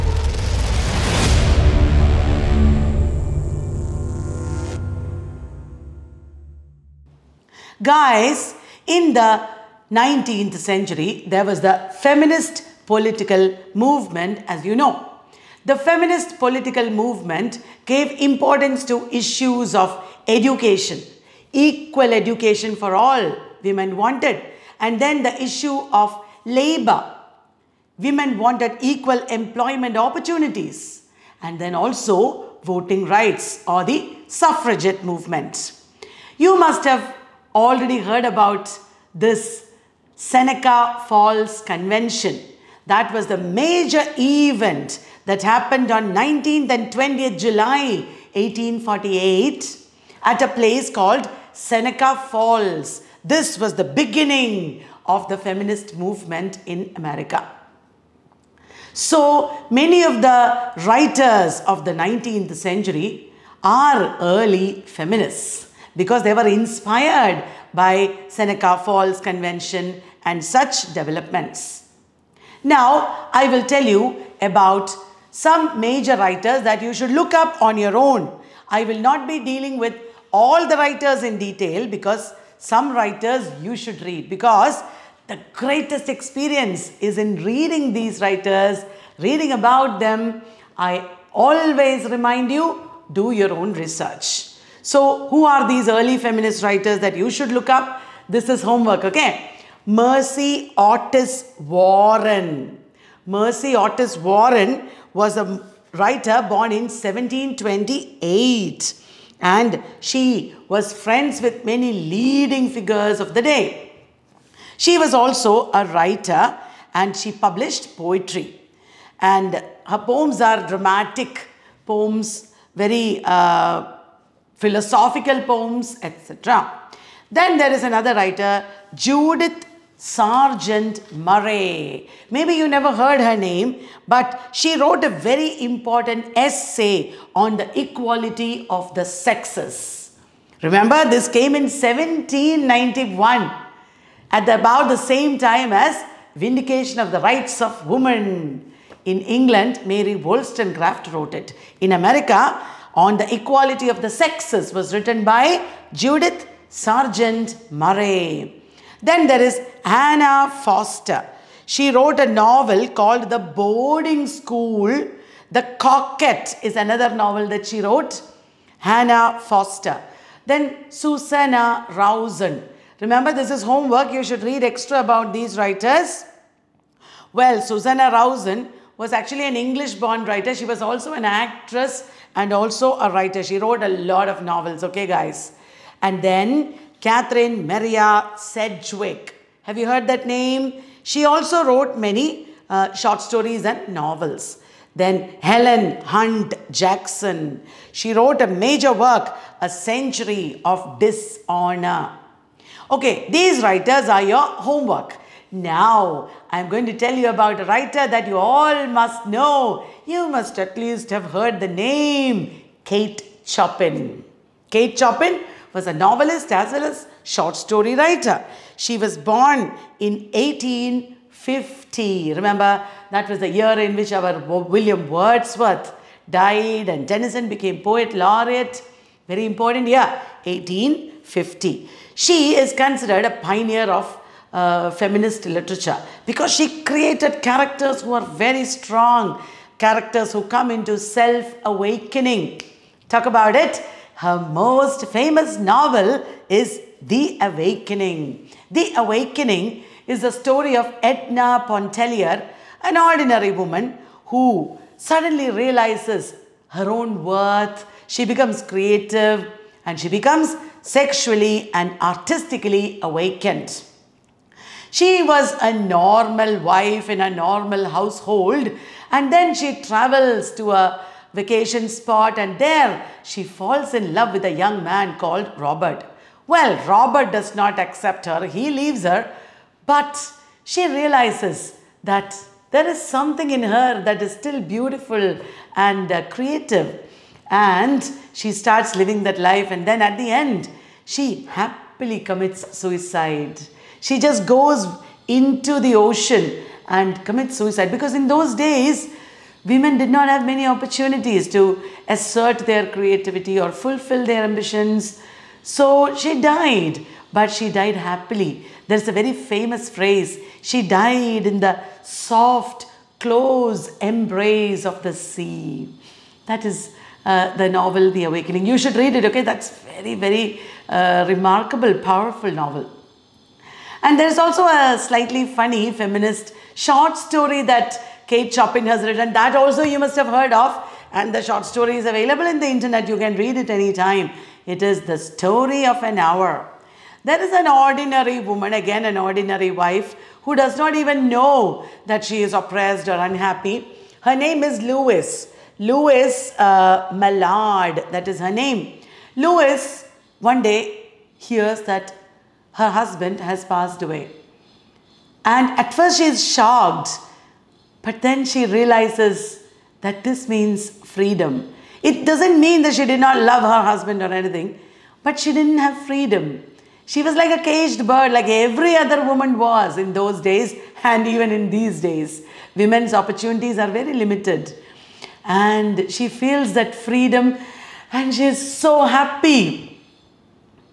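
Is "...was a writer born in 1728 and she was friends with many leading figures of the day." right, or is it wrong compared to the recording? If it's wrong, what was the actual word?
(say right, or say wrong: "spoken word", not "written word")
right.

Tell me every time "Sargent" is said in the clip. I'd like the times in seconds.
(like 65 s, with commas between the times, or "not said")
129 s, 156 s.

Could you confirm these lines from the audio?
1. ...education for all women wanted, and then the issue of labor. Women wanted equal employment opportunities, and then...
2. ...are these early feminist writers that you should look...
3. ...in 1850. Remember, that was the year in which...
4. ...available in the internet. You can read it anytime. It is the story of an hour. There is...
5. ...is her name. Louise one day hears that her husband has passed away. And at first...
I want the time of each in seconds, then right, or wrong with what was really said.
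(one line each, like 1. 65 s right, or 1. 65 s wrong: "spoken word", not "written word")
1. 22 s right
2. 95 s right
3. 219 s right
4. 332 s right
5. 348 s right.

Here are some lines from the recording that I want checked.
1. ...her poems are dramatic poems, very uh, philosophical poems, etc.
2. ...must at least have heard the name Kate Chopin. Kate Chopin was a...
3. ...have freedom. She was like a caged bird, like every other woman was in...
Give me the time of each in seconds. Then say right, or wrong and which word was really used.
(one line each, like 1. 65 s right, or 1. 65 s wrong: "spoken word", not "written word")
1. 119 s right
2. 210 s right
3. 365 s right.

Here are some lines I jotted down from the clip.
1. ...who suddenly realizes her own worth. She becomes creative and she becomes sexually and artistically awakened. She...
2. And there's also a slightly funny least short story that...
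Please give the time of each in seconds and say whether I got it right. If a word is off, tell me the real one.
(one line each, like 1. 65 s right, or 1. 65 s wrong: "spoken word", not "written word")
1. 254 s right
2. 324 s wrong: "feminist", not "least".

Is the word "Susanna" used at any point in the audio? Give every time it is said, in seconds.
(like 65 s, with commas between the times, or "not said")
170 s, 177 s.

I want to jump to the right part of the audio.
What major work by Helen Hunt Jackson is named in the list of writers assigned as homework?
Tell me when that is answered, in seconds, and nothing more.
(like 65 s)
199 s.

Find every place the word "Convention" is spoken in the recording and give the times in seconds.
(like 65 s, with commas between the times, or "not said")
41 s, 69 s.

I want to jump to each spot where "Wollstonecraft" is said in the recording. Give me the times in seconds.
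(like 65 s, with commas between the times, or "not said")
150 s.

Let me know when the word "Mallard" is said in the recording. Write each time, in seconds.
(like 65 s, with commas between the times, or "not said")
347 s.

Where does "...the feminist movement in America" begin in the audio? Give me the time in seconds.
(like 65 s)
55 s.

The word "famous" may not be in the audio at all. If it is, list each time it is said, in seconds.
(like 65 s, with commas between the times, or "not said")
245 s, 309 s.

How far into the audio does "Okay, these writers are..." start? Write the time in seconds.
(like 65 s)
202 s.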